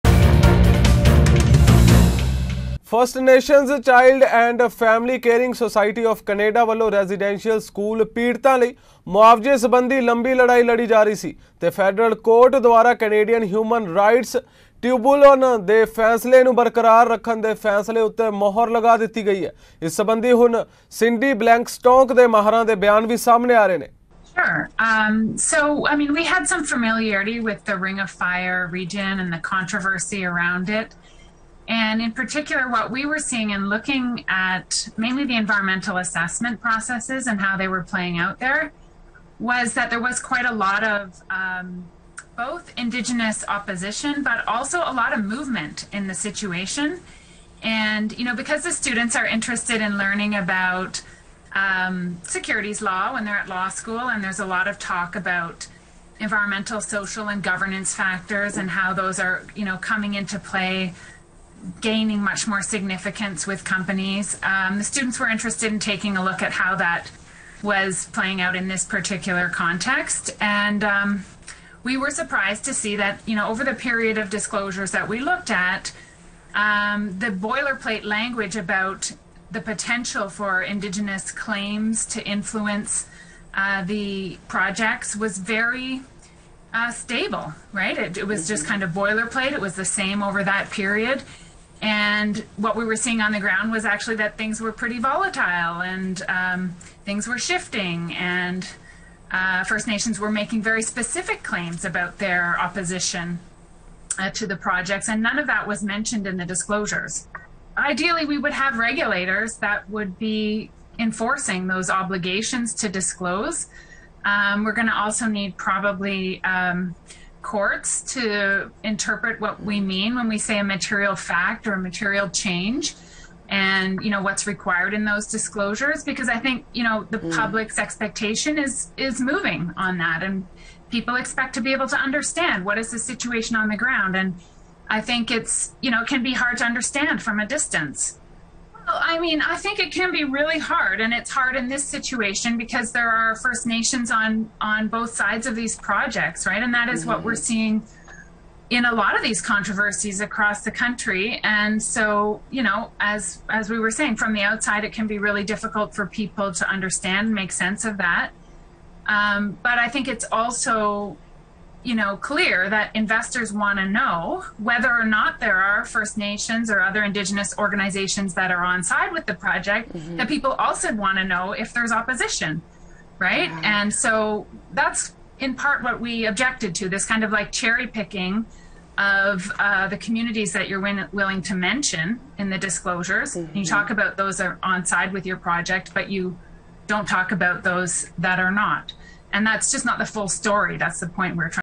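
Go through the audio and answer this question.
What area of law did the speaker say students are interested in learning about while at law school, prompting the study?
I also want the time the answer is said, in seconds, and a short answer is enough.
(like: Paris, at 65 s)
securities law, at 52 s.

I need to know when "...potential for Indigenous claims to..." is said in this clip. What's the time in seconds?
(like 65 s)
79 s.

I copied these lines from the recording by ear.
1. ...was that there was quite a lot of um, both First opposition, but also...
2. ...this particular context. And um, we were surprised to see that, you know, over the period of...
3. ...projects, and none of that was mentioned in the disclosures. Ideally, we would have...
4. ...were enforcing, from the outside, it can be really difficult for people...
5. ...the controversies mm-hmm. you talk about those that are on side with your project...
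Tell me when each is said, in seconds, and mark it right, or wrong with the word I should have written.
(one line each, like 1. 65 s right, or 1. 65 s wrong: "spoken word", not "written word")
1. 39 s wrong: "Indigenous", not "First"
2. 68 s right
3. 104 s right
4. 153 s wrong: "saying", not "enforcing"
5. 182 s wrong: "disclosures", not "controversies".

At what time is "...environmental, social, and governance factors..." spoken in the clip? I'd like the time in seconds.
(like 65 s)
56 s.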